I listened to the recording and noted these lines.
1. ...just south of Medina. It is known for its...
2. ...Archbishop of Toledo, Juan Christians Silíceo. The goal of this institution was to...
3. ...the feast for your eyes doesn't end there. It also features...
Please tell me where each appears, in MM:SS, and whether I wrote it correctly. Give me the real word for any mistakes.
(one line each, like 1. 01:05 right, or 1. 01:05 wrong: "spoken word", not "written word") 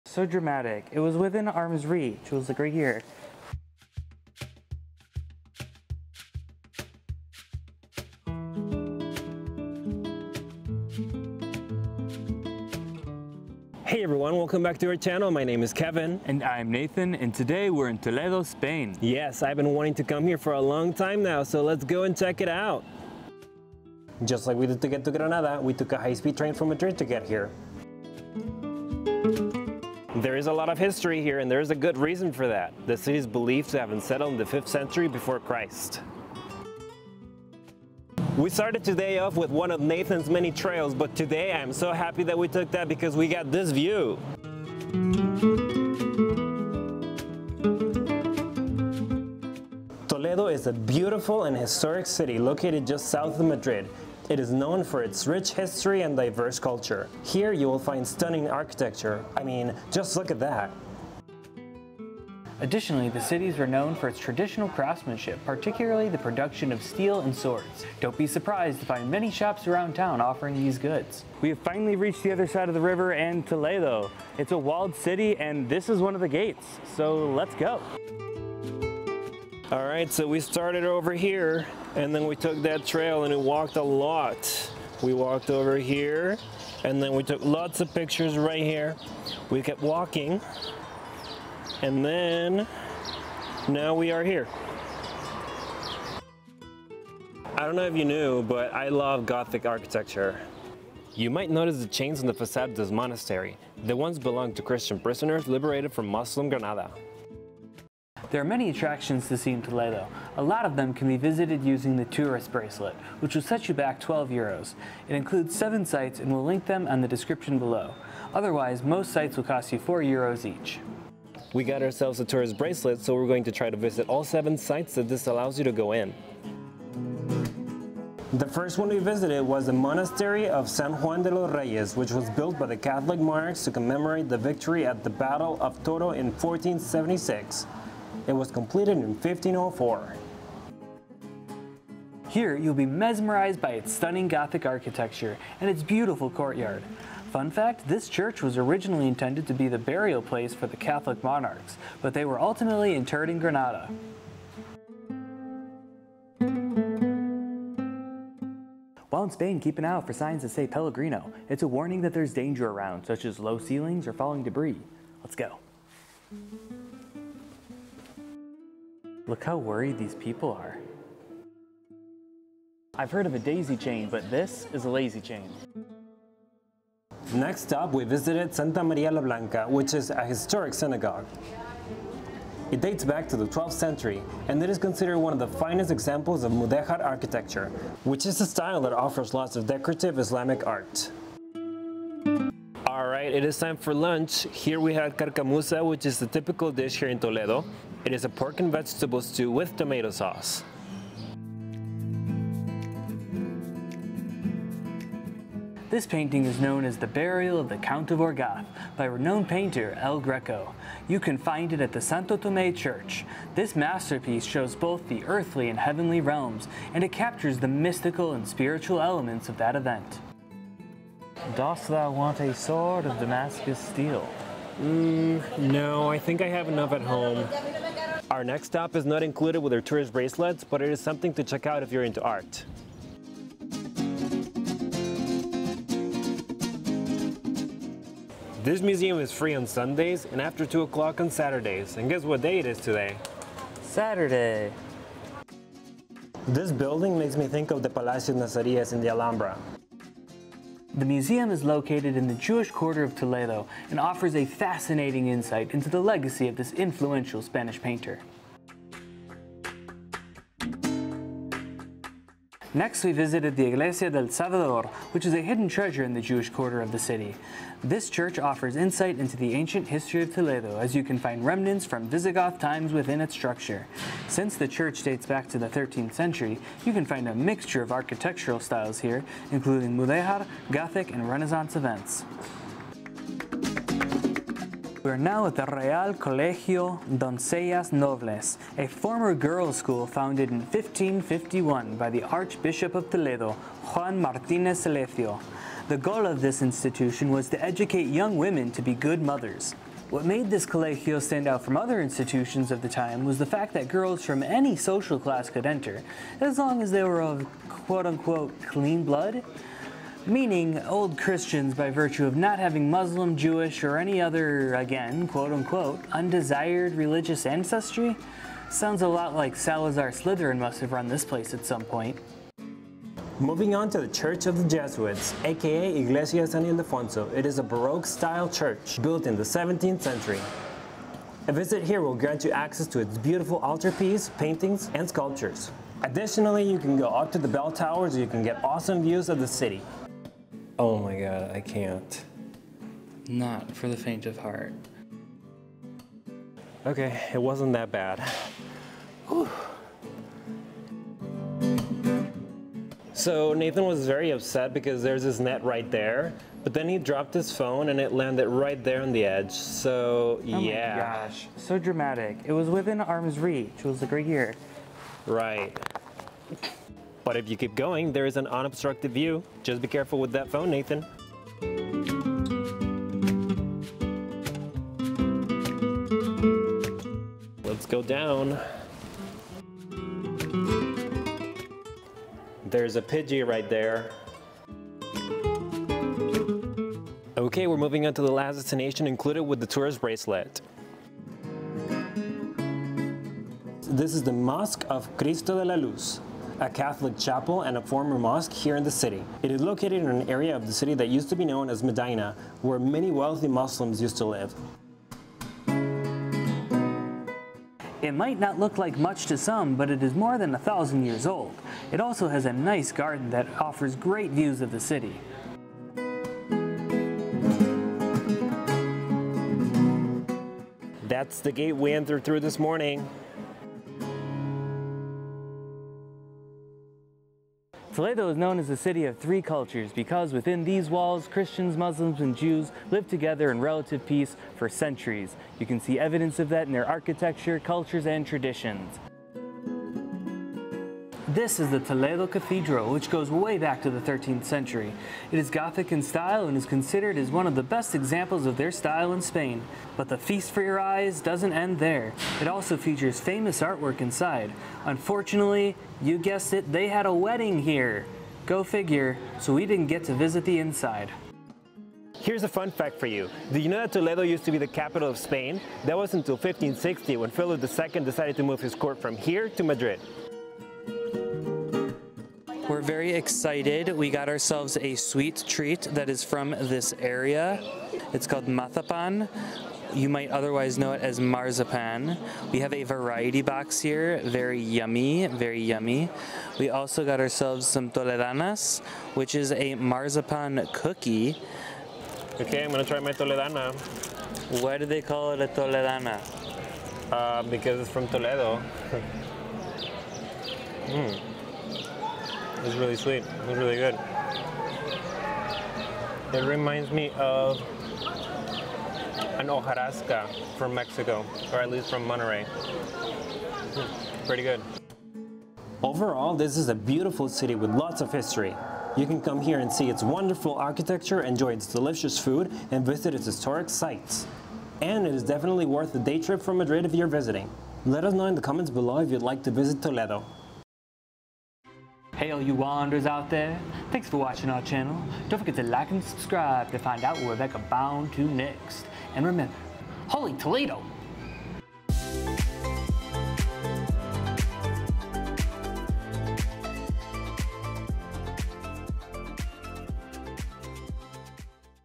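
1. 00:52 wrong: "Madrid", not "Medina"
2. 04:52 wrong: "Martinez", not "Christians"
3. 07:30 right.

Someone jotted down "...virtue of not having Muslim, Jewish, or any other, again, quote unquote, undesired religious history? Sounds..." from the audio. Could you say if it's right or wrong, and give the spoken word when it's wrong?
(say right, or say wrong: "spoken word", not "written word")
wrong: "ancestry", not "history".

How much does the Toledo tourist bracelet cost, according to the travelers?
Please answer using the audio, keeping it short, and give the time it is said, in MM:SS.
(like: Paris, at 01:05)
12 euros, at 01:53.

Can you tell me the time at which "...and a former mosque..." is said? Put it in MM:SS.
06:37.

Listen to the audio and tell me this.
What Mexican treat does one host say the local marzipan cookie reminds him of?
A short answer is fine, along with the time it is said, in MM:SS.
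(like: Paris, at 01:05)
Hojarasca, at 08:29.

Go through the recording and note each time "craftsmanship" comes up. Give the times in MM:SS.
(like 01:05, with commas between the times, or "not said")
01:04.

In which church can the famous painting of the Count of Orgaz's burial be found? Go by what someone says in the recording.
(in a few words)
Santo Tomé Church.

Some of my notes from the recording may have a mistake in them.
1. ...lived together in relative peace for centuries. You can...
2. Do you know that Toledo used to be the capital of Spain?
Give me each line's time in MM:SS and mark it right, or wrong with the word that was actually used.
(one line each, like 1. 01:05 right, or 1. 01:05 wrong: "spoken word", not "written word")
1. 07:12 right
2. 07:43 right.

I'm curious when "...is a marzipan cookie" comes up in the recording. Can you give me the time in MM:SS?
08:09.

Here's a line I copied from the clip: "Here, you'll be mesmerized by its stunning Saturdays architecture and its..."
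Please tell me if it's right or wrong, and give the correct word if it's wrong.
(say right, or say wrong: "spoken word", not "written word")
wrong: "Gothic", not "Saturdays".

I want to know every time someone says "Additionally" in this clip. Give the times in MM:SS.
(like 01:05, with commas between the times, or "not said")
01:02, 05:36.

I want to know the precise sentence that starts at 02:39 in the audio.
While in Spain, keep an eye out for signs that say Peligro.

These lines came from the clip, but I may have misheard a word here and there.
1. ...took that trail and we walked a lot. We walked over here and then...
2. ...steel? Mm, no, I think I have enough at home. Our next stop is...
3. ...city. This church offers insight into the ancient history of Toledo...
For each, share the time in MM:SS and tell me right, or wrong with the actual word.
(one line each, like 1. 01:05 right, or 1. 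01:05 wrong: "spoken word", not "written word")
1. 01:22 right
2. 03:43 right
3. 04:26 right.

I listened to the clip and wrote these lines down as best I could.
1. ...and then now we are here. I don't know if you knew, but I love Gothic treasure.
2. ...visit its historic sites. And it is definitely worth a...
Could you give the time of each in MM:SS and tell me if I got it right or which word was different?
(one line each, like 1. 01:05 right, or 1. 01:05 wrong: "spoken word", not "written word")
1. 01:31 wrong: "architecture", not "treasure"
2. 08:42 right.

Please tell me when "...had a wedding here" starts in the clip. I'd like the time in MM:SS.
07:36.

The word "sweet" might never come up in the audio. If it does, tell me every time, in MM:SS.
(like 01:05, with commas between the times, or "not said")
07:54, 08:22.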